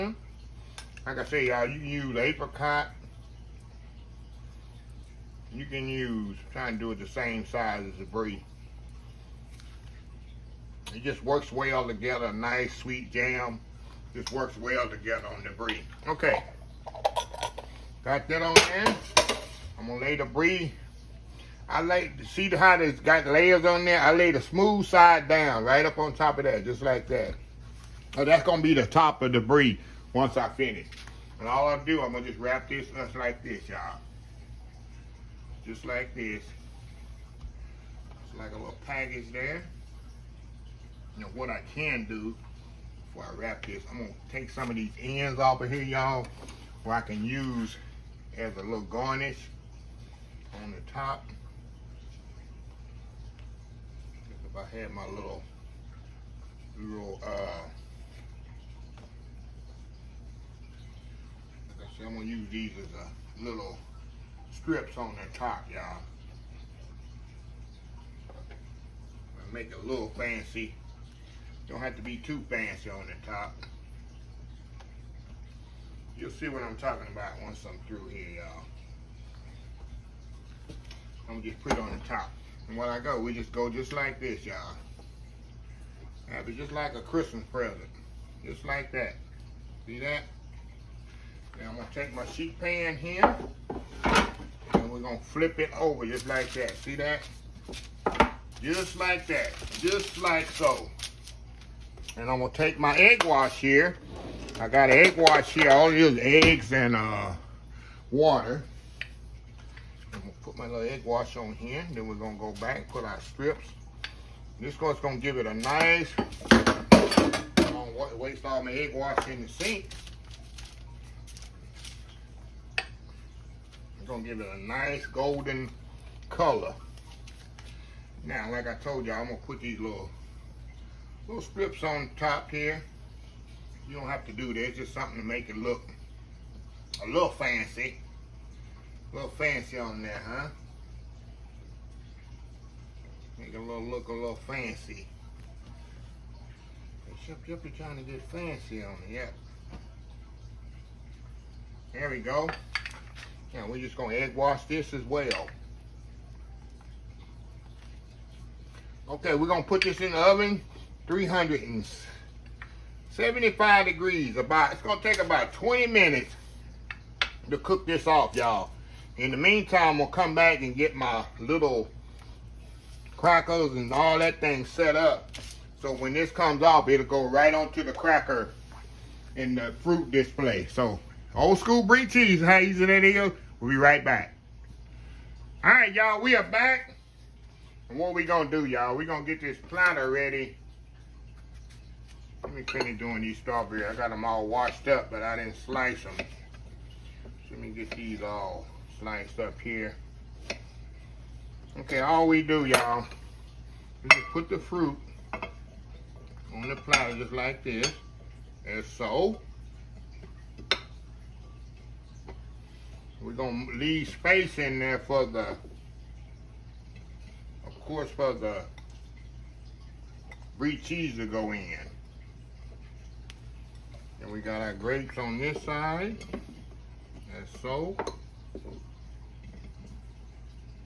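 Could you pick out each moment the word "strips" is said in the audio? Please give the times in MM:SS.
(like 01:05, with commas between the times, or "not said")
01:04, 01:53, 02:11.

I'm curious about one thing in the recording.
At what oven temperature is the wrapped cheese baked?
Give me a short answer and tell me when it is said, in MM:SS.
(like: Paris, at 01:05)
375 degrees, at 02:41.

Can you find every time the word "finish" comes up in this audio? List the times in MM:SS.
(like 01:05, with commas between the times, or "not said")
00:30, 03:12.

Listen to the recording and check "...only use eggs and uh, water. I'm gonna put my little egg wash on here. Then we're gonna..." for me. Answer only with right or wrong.
right.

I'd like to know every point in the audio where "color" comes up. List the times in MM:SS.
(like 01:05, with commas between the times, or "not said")
02:06.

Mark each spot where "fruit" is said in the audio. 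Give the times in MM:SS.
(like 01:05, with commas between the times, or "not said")
02:59, 03:24.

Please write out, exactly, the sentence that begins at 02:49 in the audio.
In the meantime, we'll come back and get my little crackers and all that thing set up.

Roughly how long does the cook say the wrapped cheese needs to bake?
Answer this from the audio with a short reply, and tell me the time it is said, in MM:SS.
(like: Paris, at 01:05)
20 minutes, at 02:45.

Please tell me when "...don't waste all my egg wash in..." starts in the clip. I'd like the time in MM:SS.
01:57.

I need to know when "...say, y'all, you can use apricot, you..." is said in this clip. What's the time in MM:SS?
00:01.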